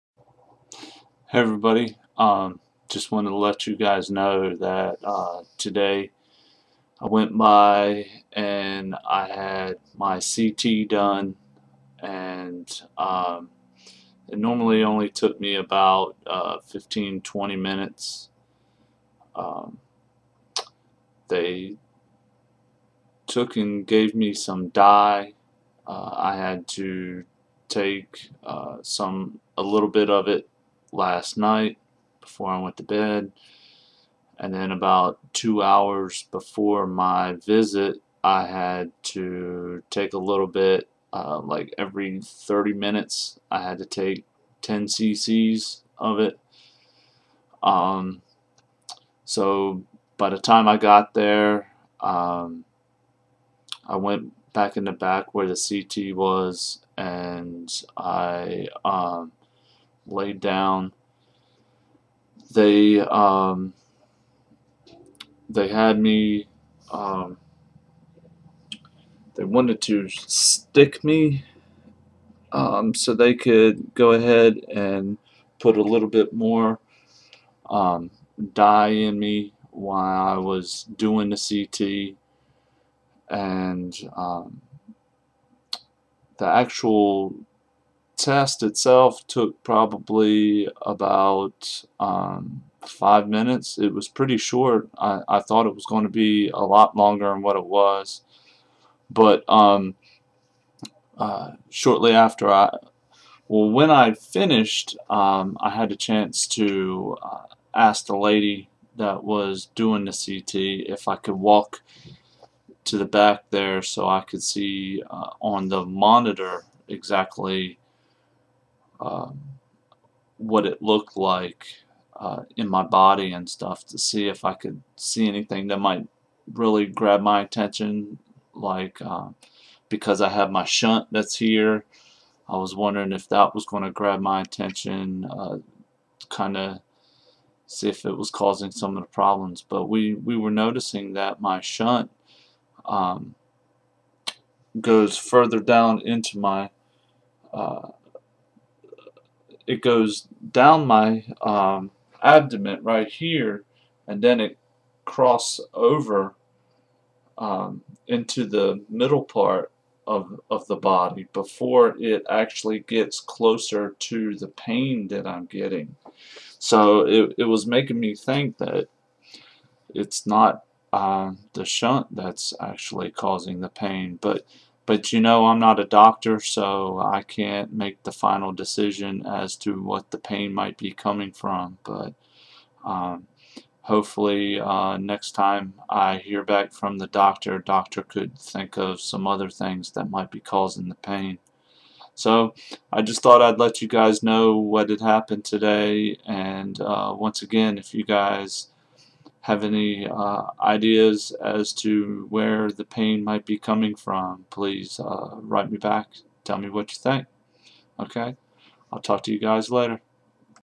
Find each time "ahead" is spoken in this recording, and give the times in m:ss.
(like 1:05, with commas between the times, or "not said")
1:14.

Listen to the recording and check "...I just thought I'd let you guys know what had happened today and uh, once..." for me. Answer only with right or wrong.
right.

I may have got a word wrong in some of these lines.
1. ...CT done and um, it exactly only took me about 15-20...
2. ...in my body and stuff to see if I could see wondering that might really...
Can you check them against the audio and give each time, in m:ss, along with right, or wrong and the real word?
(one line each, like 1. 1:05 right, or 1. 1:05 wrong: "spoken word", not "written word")
1. 0:10 wrong: "normally", not "exactly"
2. 2:02 wrong: "anything", not "wondering".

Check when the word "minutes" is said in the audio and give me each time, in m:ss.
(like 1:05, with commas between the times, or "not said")
0:17, 0:42, 1:33.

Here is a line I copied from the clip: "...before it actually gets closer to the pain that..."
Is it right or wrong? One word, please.
right.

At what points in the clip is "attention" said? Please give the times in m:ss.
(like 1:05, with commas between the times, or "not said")
2:07, 2:14.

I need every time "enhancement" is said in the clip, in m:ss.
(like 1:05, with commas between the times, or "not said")
not said.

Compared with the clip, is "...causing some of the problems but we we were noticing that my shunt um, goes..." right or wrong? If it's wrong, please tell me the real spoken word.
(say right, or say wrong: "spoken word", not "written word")
right.